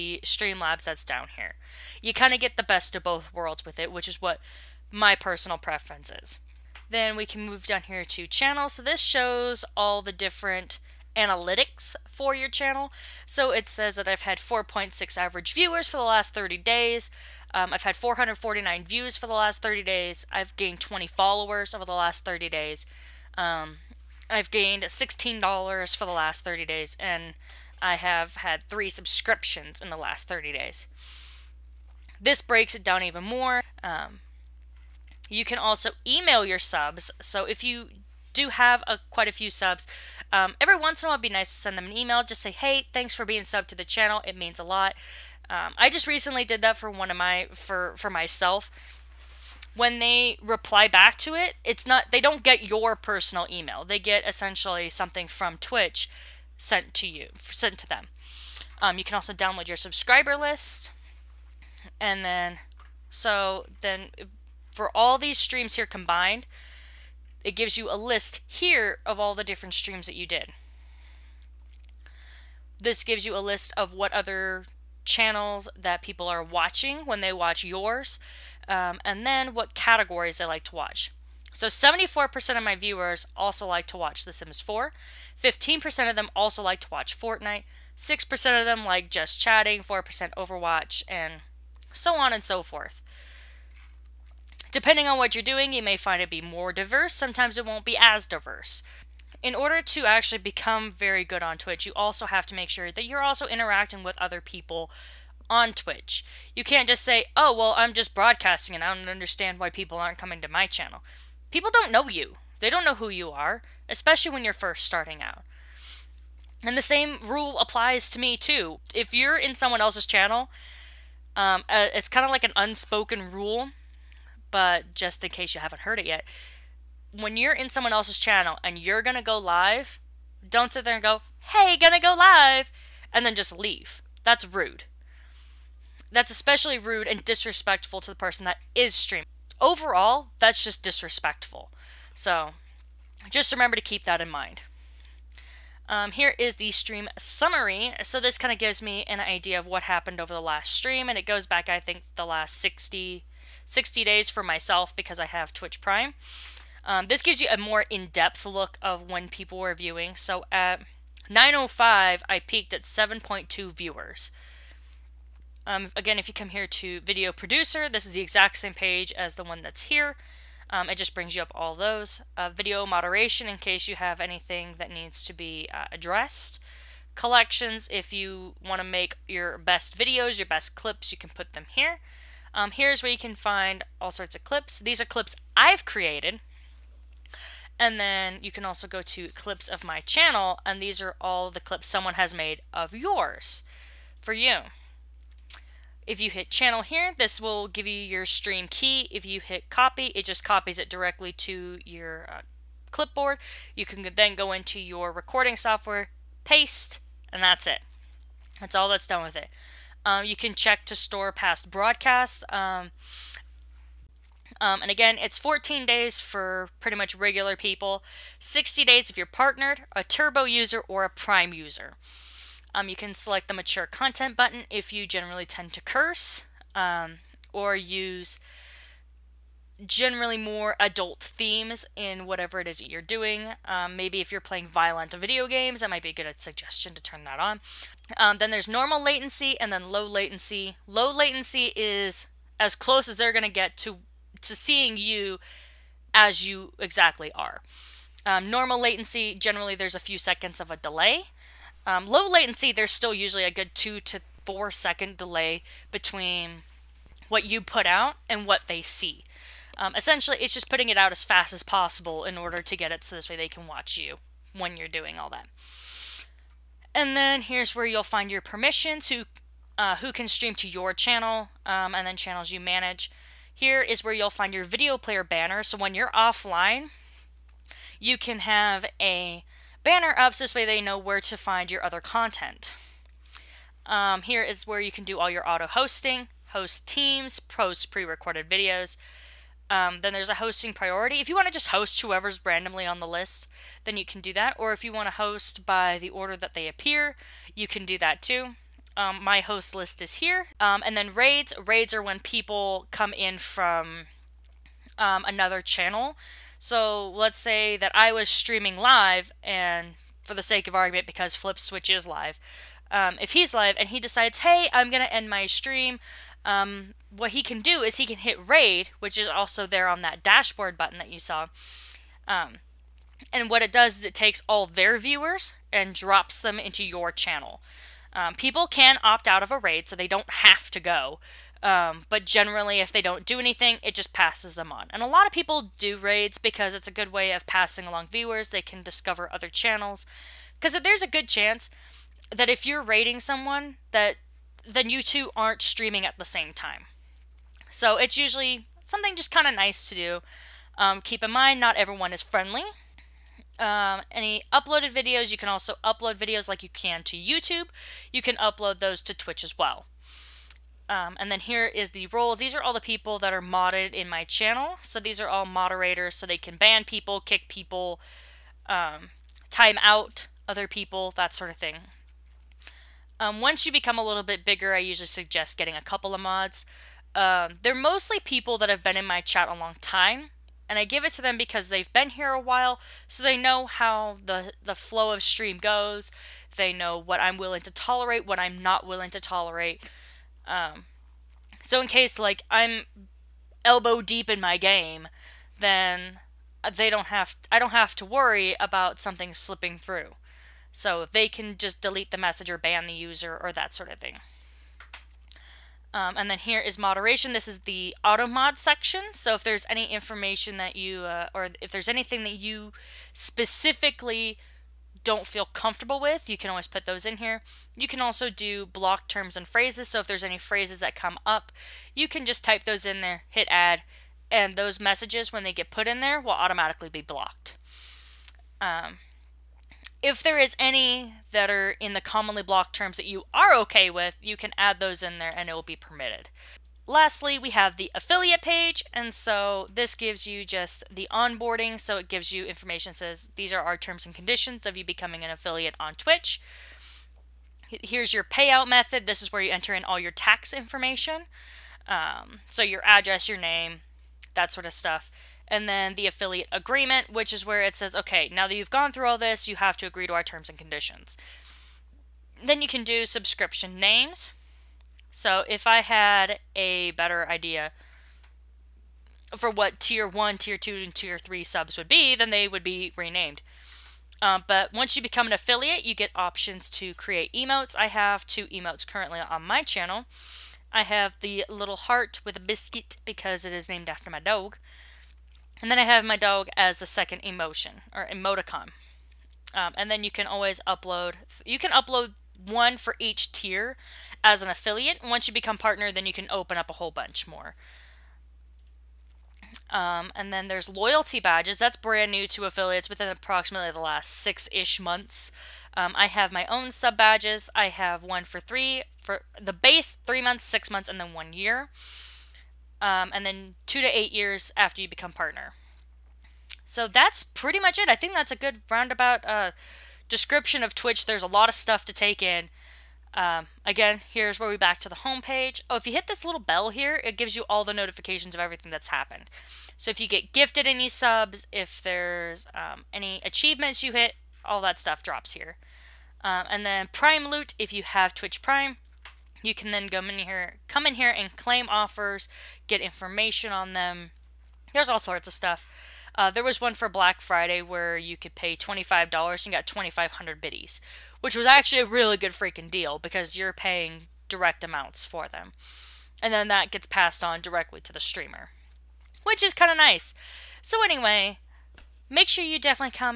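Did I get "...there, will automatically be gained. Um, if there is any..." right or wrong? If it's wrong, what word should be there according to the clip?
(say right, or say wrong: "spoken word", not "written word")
wrong: "blocked", not "gained".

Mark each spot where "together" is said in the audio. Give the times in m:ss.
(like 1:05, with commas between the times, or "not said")
not said.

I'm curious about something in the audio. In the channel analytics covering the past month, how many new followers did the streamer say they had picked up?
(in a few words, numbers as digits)
20.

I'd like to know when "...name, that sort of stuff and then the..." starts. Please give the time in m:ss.
7:33.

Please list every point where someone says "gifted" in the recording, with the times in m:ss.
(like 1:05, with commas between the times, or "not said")
8:50.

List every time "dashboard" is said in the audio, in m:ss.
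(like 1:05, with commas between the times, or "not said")
5:20.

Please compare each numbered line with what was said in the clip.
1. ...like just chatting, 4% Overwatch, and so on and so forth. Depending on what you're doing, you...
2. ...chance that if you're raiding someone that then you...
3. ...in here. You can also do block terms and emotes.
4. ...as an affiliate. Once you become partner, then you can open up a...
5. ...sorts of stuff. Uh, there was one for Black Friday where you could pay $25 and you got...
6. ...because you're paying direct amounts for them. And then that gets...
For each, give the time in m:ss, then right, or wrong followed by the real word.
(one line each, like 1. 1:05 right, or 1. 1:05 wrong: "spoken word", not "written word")
1. 1:28 right
2. 5:41 right
3. 6:57 wrong: "phrases", not "emotes"
4. 8:14 right
5. 9:04 right
6. 9:12 right.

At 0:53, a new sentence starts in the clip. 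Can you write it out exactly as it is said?
They get essentially something from Twitch sent to you, sent to them.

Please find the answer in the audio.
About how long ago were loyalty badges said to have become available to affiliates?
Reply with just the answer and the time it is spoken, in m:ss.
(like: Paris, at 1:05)
About 6 months, at 8:24.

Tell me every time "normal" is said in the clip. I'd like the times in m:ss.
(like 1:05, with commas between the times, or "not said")
3:58, 4:08.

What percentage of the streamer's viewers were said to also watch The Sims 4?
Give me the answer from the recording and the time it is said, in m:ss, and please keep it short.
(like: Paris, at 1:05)
74%, at 1:21.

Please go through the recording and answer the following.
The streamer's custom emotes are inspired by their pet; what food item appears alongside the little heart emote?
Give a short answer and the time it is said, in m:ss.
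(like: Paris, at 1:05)
A biscuit, at 8:02.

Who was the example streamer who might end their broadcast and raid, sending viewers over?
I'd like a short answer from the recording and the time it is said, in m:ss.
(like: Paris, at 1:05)
Flip Switch, at 5:11.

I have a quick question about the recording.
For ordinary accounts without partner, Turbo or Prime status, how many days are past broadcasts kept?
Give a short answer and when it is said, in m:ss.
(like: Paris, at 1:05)
14 days, at 3:35.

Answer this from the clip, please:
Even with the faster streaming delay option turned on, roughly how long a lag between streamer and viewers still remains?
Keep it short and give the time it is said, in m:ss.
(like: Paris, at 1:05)
2 to 4 seconds, at 4:13.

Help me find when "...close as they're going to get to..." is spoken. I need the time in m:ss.
4:02.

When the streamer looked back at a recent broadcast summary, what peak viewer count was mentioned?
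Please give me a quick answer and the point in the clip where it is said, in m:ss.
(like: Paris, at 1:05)
7.2, at 2:42.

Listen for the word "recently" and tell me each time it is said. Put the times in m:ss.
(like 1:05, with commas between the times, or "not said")
0:46.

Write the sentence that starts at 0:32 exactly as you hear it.
This breaks it down even more.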